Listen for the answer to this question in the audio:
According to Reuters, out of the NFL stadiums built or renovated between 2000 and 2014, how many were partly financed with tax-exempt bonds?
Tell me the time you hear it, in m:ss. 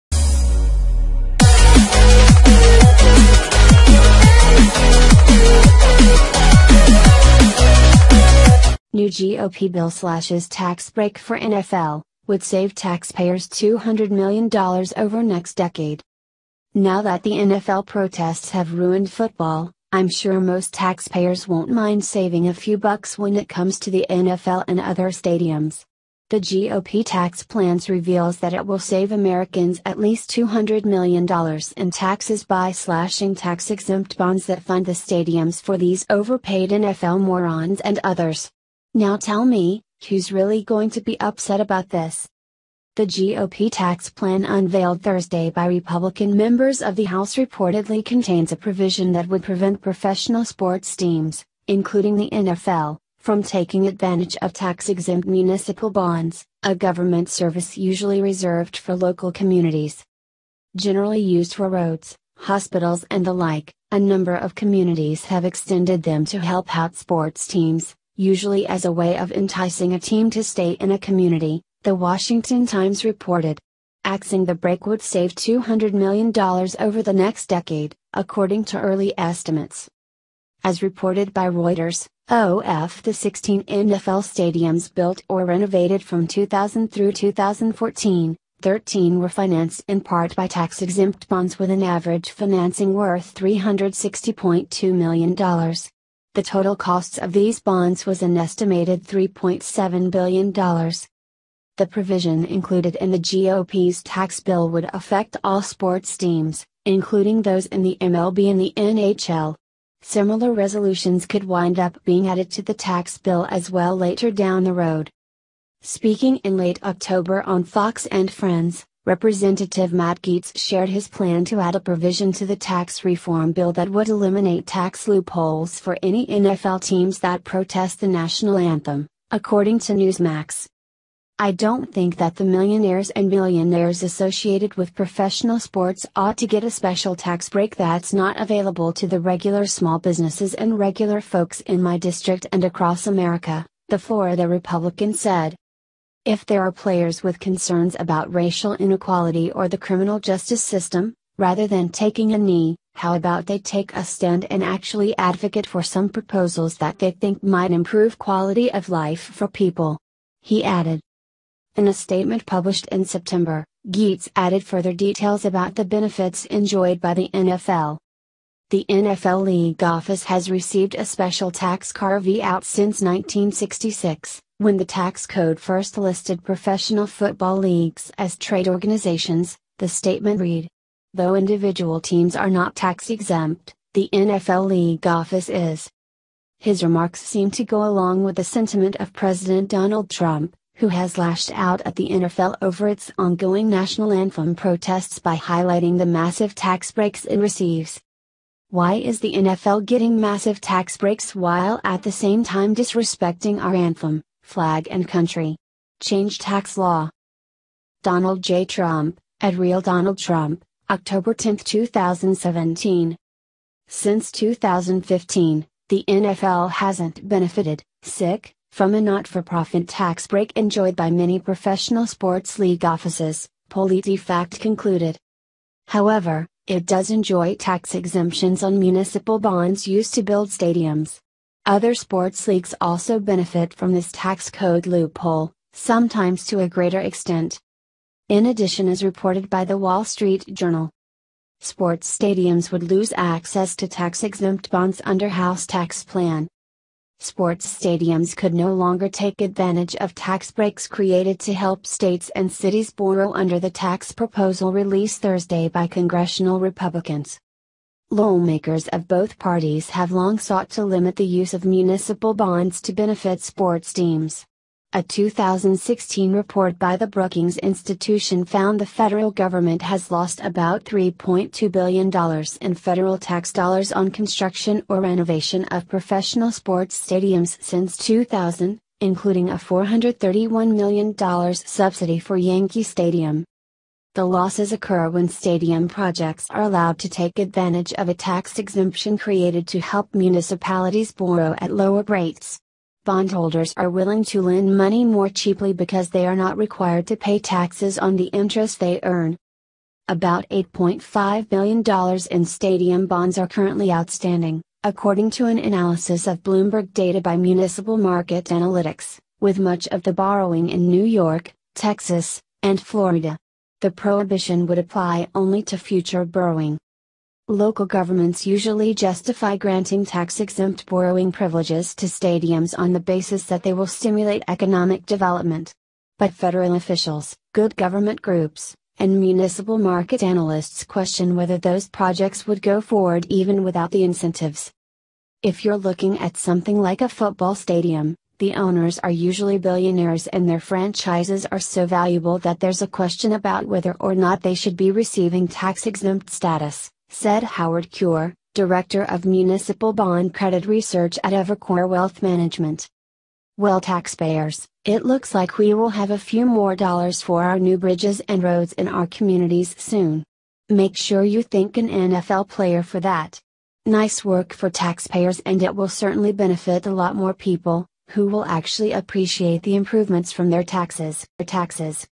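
1:28.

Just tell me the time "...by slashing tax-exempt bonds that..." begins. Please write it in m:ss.
0:32.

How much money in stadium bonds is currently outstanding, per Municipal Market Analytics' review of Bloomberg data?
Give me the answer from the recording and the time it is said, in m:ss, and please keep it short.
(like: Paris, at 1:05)
$8.5 billion, at 5:00.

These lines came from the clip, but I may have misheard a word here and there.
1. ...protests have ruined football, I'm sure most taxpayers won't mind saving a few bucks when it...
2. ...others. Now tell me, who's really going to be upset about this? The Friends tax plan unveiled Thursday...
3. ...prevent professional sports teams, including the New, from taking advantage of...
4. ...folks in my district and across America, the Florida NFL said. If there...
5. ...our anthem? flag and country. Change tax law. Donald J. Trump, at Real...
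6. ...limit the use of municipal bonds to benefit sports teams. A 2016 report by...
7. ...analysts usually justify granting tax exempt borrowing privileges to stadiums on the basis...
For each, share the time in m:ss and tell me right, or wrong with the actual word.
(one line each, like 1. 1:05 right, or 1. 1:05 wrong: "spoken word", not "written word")
1. 0:17 right
2. 0:38 wrong: "GOP", not "Friends"
3. 0:49 wrong: "NFL", not "New"
4. 2:21 wrong: "Republican", not "NFL"
5. 3:23 right
6. 4:20 right
7. 5:17 wrong: "governments", not "analysts".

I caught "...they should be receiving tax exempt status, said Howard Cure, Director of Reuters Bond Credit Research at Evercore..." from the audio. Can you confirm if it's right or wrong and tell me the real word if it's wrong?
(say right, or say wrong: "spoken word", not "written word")
wrong: "Municipal", not "Reuters".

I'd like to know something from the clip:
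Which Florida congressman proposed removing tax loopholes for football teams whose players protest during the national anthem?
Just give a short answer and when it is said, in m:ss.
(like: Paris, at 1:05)
Matt Gaetz, at 1:59.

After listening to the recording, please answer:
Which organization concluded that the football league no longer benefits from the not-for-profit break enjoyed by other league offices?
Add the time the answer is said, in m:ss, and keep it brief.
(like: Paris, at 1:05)
PolitiFact, at 3:43.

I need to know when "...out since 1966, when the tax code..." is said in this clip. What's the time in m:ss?
2:52.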